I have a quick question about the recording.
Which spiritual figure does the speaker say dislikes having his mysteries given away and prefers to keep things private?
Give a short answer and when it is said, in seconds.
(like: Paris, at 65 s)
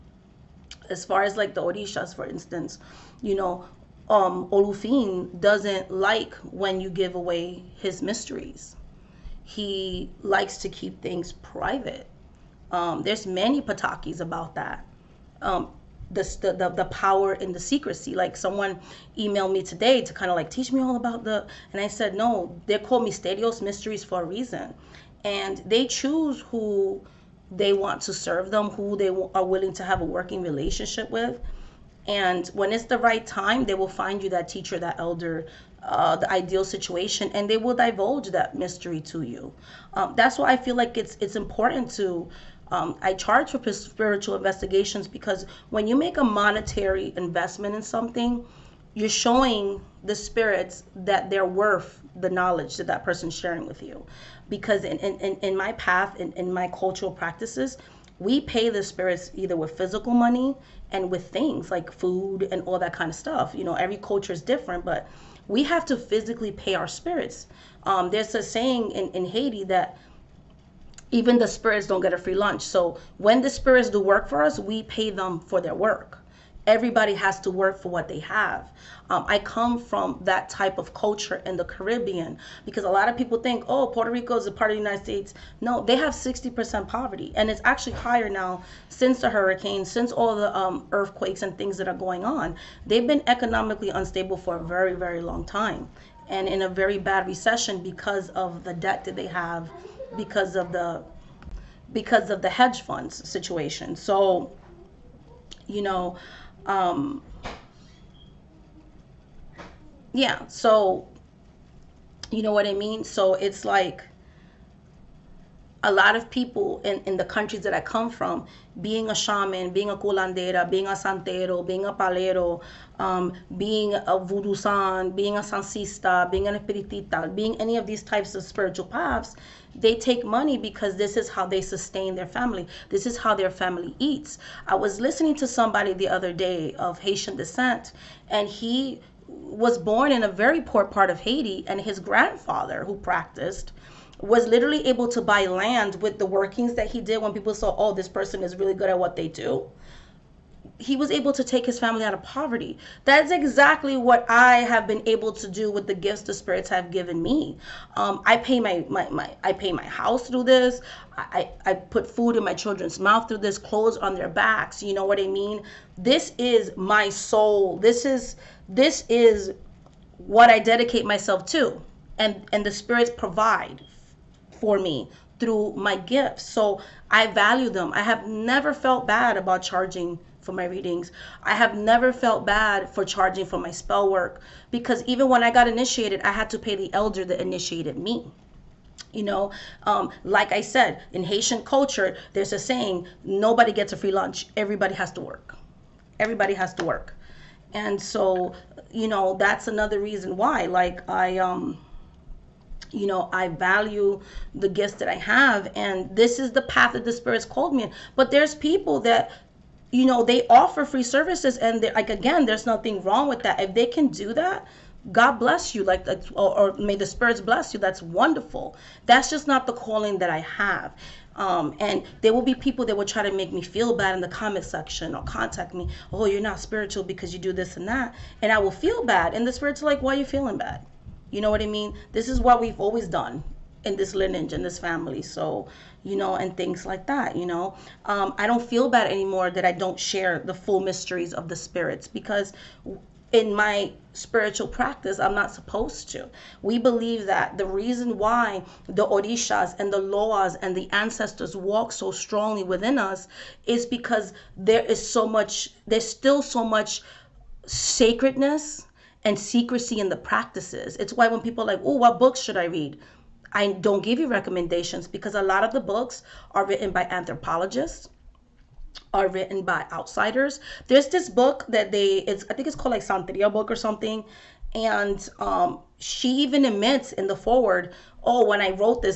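Olofin, at 4 s.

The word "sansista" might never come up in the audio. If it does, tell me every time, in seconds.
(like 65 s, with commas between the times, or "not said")
125 s.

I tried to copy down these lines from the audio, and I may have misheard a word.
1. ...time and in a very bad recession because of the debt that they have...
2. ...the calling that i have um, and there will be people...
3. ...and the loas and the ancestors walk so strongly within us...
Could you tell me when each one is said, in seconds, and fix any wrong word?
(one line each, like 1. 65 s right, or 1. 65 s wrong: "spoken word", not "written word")
1. 95 s right
2. 219 s right
3. 249 s right.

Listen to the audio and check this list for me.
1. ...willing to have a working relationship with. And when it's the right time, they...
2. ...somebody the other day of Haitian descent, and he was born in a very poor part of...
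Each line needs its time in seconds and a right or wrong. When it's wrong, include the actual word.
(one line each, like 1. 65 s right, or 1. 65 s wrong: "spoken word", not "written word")
1. 29 s right
2. 135 s right.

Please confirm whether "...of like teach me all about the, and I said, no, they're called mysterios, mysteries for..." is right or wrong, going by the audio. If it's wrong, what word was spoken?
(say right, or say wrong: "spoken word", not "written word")
right.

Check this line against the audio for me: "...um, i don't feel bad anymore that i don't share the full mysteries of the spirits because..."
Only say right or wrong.
right.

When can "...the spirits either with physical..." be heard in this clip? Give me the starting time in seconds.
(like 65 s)
58 s.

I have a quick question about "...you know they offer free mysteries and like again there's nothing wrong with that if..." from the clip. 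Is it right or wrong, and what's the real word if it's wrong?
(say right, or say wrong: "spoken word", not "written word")
wrong: "services", not "mysteries".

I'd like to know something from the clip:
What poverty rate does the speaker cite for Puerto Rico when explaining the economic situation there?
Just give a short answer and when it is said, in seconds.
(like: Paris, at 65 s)
60%, at 86 s.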